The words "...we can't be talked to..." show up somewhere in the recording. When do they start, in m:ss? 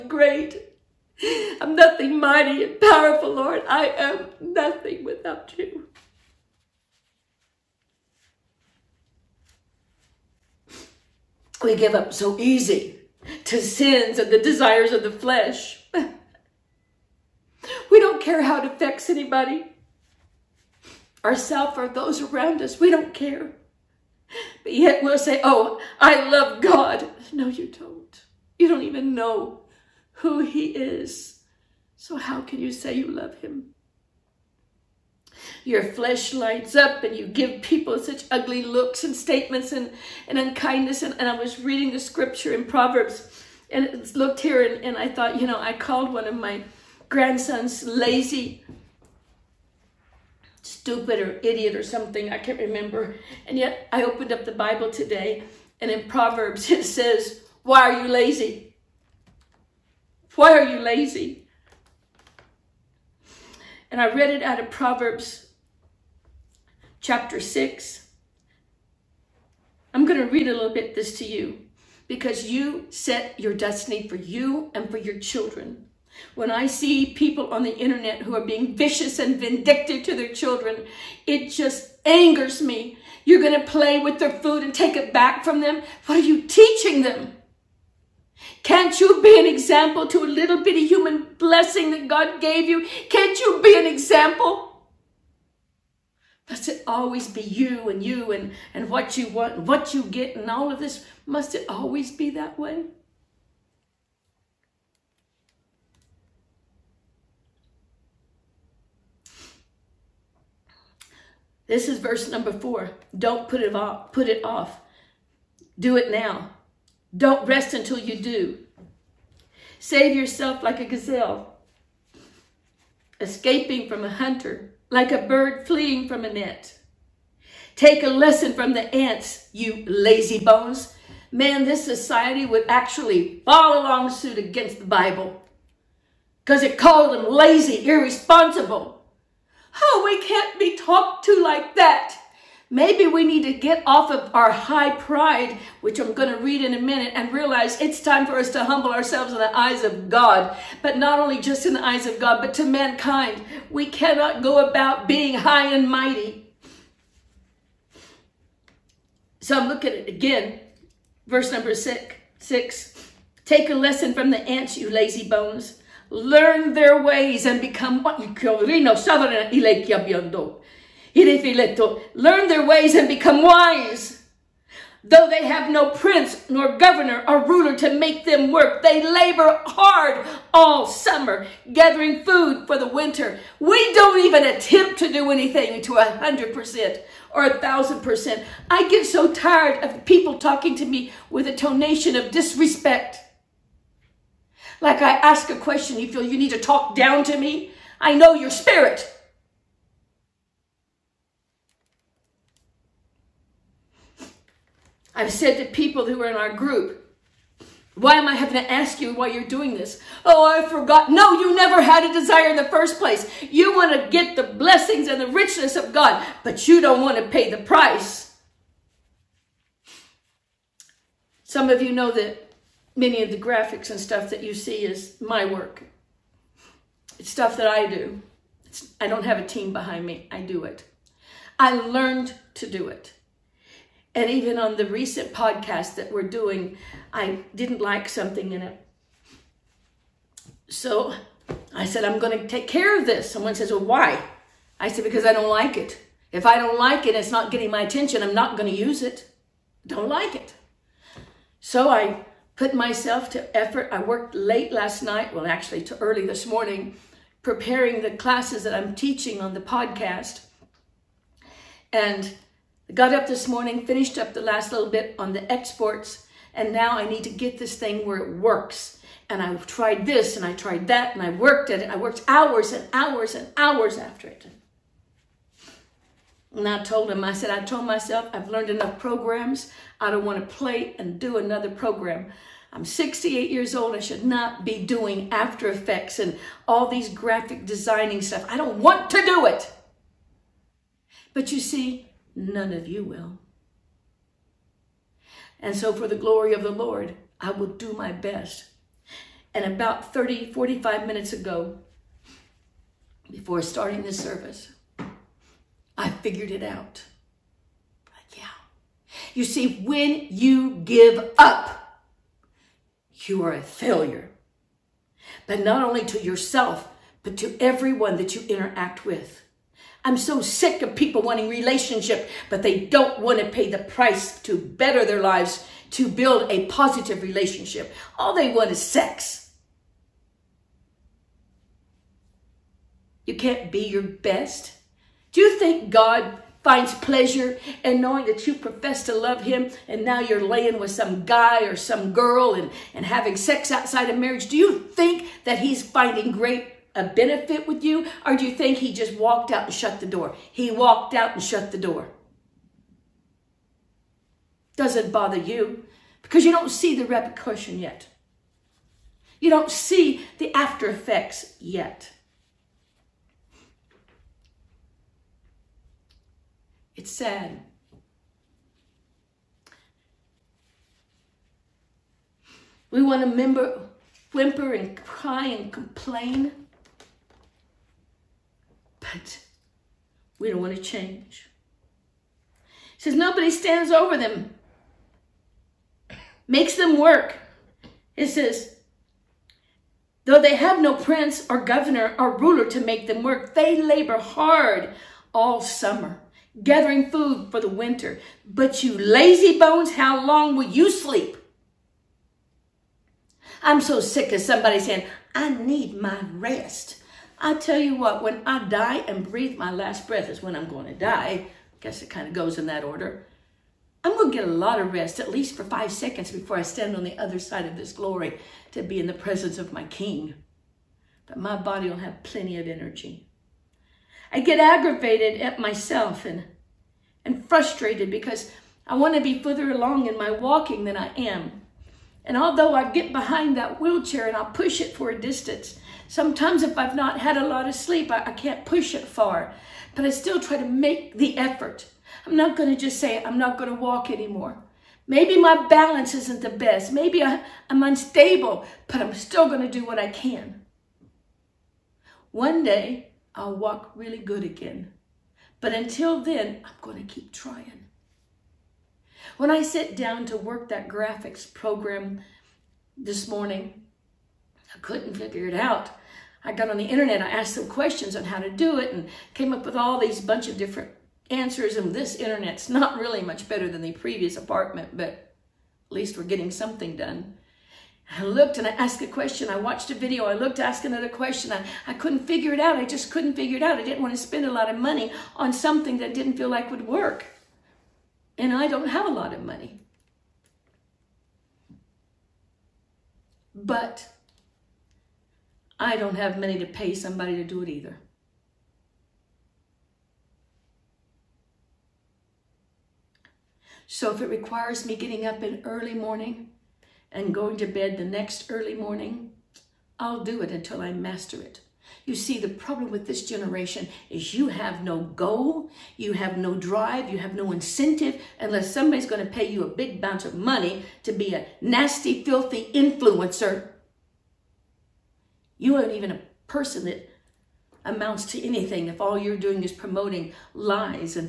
2:20.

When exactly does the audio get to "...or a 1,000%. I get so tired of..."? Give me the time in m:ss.
3:07.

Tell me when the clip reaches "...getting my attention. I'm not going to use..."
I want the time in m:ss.
4:07.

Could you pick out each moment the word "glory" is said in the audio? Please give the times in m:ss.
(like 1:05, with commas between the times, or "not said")
4:56, 6:57.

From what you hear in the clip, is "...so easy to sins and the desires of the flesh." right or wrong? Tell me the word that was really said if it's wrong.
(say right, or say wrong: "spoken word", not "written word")
right.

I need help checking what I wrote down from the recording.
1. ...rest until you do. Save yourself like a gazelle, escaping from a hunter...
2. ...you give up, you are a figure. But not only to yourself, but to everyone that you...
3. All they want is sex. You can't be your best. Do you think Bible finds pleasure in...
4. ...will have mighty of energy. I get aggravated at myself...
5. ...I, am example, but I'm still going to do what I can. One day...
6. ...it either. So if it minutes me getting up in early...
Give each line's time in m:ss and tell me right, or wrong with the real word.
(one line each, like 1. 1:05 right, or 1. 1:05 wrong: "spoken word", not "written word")
1. 1:57 right
2. 5:10 wrong: "failure", not "figure"
3. 5:28 wrong: "God", not "Bible"
4. 7:01 wrong: "plenty", not "mighty"
5. 7:27 wrong: "unstable", not "example"
6. 8:17 wrong: "requires", not "minutes".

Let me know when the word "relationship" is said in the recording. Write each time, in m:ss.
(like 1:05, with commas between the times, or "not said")
5:21, 5:27.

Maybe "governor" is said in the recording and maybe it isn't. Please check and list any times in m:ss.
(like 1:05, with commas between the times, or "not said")
2:56, 6:31.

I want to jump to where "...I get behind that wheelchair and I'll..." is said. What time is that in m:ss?
7:12.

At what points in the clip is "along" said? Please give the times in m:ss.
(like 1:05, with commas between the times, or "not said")
2:13, 7:09.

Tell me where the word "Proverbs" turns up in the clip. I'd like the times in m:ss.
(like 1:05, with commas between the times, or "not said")
0:42, 0:56, 1:04.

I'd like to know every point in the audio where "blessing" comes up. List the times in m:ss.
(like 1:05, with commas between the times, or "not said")
1:31, 3:34.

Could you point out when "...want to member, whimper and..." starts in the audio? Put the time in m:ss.
6:13.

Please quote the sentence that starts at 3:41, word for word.
Some of you know that many of the graphics and stuff that you see is my work.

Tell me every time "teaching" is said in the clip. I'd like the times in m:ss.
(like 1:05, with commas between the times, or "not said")
1:26, 4:18.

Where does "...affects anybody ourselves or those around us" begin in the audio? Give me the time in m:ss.
0:18.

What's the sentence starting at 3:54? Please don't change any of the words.
And even on the recent podcast that we're doing, I didn't like something in it.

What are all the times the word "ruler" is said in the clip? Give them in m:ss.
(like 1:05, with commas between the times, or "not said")
2:57, 6:32.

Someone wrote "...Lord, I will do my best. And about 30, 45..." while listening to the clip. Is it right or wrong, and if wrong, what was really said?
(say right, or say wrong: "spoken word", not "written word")
right.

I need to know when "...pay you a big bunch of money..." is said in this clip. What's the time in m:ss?
8:39.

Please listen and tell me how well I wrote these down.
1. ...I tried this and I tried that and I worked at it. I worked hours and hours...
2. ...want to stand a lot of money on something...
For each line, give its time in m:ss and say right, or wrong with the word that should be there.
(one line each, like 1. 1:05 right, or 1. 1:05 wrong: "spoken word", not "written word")
1. 4:29 right
2. 8:04 wrong: "spend", not "stand".